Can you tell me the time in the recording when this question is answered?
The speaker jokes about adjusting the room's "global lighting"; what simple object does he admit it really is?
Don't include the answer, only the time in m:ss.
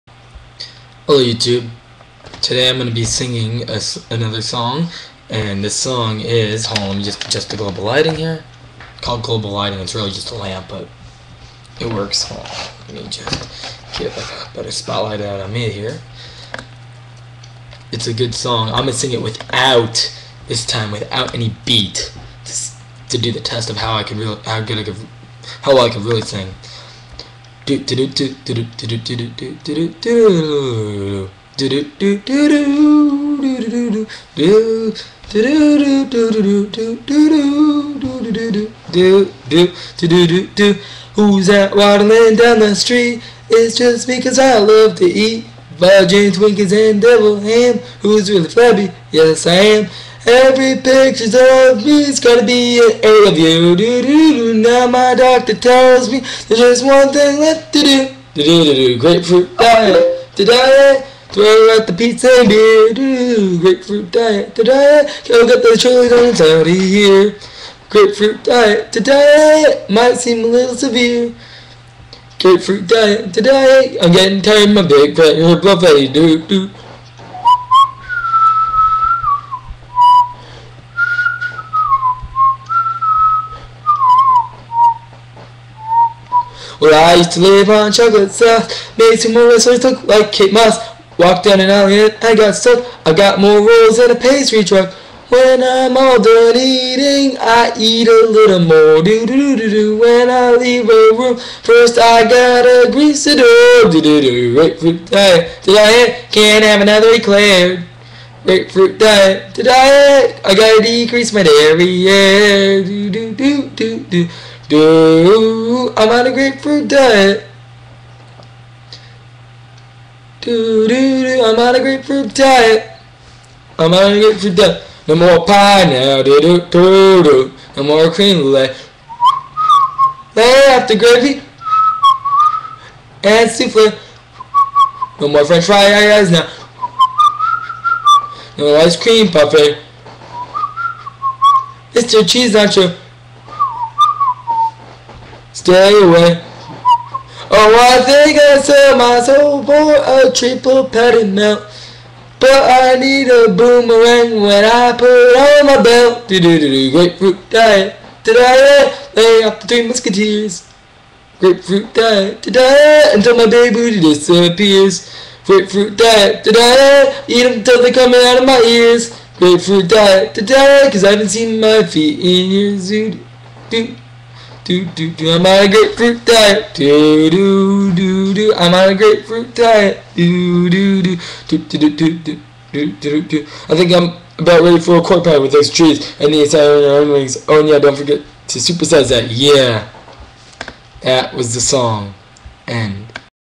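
0:10.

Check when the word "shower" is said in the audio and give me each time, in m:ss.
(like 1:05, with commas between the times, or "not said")
not said.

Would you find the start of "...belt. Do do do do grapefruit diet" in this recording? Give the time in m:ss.
2:35.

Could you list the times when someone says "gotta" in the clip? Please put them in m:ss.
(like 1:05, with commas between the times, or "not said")
0:52, 1:42, 1:50.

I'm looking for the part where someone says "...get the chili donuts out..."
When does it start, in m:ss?
1:05.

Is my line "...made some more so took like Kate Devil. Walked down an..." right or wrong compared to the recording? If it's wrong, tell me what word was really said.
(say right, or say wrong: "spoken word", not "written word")
wrong: "Moss", not "Devil".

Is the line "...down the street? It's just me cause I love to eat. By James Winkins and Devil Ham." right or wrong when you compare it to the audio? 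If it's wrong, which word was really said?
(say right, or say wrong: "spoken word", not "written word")
right.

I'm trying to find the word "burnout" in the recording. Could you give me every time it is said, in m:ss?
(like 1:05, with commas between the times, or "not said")
not said.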